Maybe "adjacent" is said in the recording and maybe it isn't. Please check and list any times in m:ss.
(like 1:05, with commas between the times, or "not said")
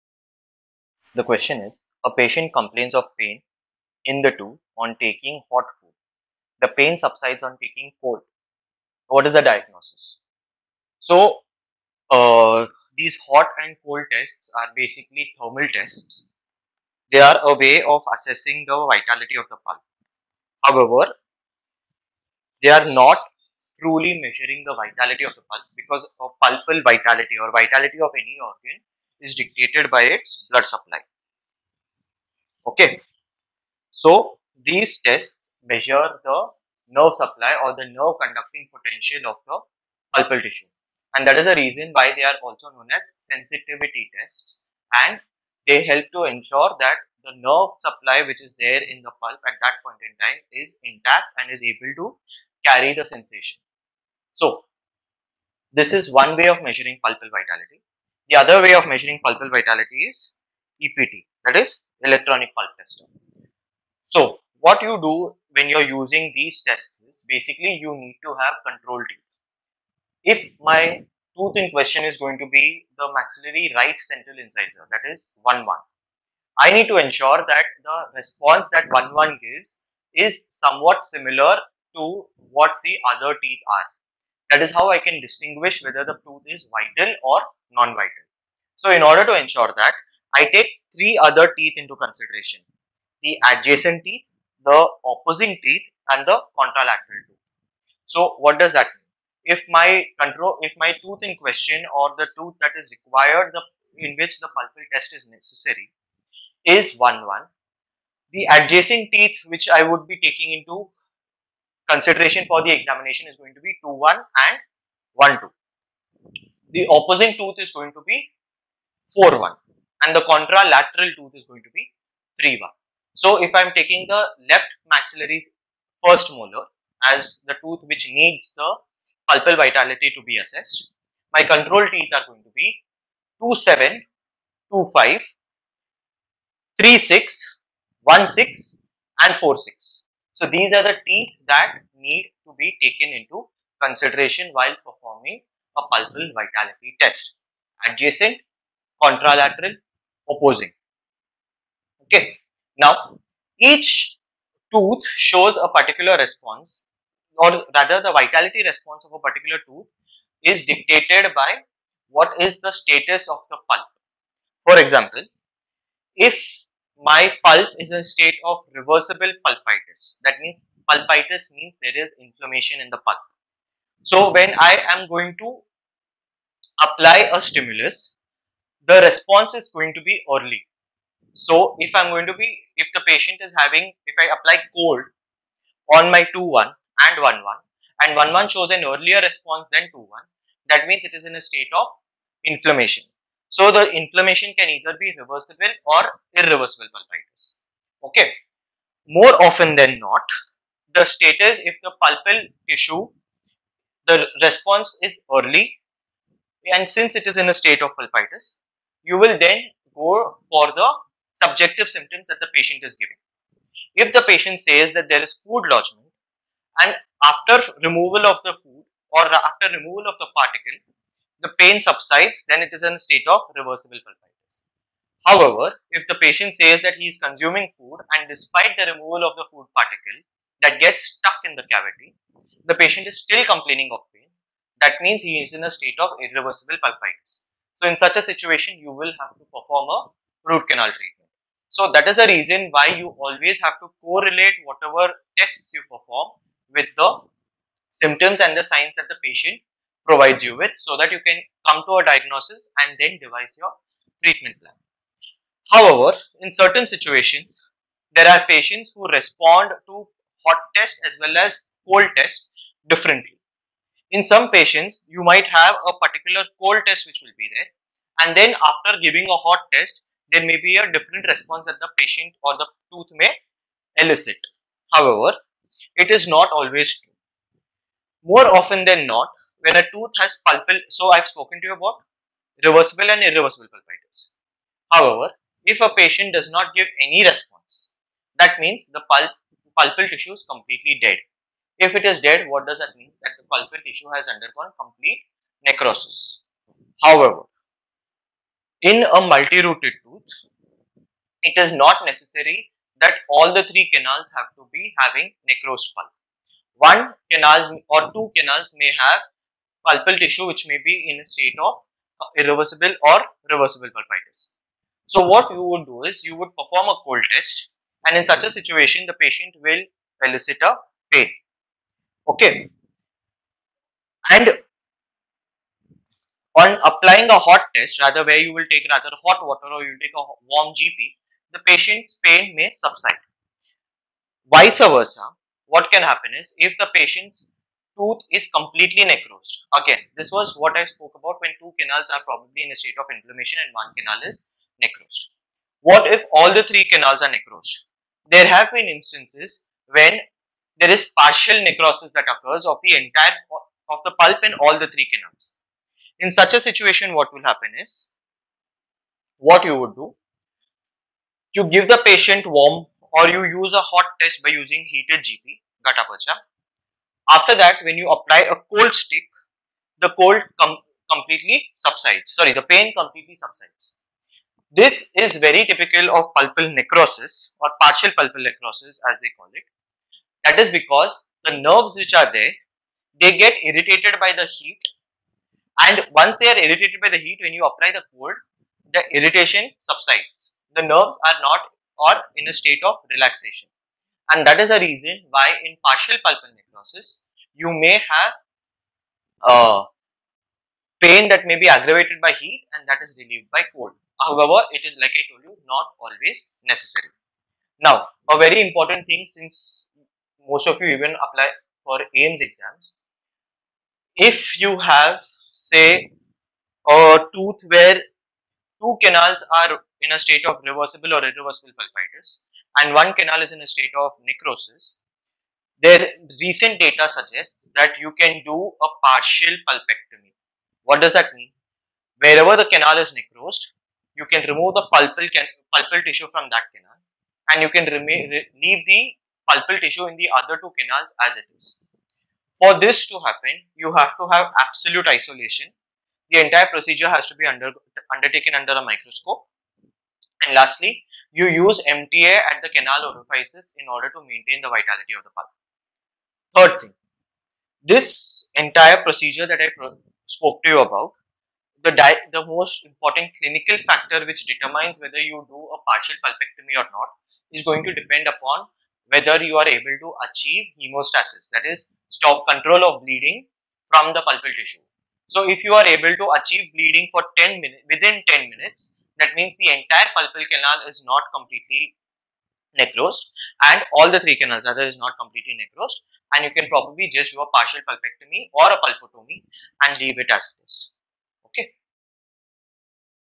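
1:33, 1:48, 2:27.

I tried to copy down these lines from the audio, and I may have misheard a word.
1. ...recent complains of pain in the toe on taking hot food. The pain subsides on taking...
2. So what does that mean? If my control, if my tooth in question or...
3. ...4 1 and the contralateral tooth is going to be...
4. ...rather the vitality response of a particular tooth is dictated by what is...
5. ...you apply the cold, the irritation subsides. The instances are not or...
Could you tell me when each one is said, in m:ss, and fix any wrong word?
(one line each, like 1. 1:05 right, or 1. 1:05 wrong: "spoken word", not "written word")
1. 0:02 wrong: "patient", not "recent"
2. 1:38 right
3. 1:59 right
4. 2:37 right
5. 6:27 wrong: "nerves", not "instances".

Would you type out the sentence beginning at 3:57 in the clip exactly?
So, in such a situation, you will have to perform a root canal treatment.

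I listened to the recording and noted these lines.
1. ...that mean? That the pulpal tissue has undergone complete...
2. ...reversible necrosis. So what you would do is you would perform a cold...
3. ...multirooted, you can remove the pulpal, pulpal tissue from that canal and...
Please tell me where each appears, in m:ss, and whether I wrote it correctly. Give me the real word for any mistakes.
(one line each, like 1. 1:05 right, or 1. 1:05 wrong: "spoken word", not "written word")
1. 4:52 right
2. 5:13 wrong: "pulpitis", not "necrosis"
3. 7:13 wrong: "necrosed", not "multirooted".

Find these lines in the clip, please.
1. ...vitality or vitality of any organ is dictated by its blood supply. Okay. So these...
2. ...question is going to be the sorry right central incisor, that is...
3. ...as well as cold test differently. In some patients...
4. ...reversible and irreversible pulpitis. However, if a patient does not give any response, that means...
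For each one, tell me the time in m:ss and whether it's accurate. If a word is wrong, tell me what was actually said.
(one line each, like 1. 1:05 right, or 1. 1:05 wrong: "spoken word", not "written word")
1. 0:26 right
2. 1:11 wrong: "maxillary", not "sorry"
3. 4:21 right
4. 4:42 right.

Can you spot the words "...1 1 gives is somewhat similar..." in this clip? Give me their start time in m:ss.
1:18.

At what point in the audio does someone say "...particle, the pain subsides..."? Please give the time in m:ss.
3:40.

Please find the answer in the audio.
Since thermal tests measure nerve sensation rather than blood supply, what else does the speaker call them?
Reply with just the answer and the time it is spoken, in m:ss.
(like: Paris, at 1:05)
Sensitivity tests, at 0:43.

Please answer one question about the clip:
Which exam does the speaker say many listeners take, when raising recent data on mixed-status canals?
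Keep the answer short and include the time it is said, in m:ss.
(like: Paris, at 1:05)
AIIMS, at 6:52.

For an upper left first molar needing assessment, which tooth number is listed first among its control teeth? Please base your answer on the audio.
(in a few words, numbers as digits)
27.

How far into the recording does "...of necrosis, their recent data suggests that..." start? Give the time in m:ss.
7:04.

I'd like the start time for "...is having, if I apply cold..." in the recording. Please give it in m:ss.
3:03.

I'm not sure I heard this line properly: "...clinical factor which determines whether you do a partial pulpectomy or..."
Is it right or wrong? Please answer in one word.
right.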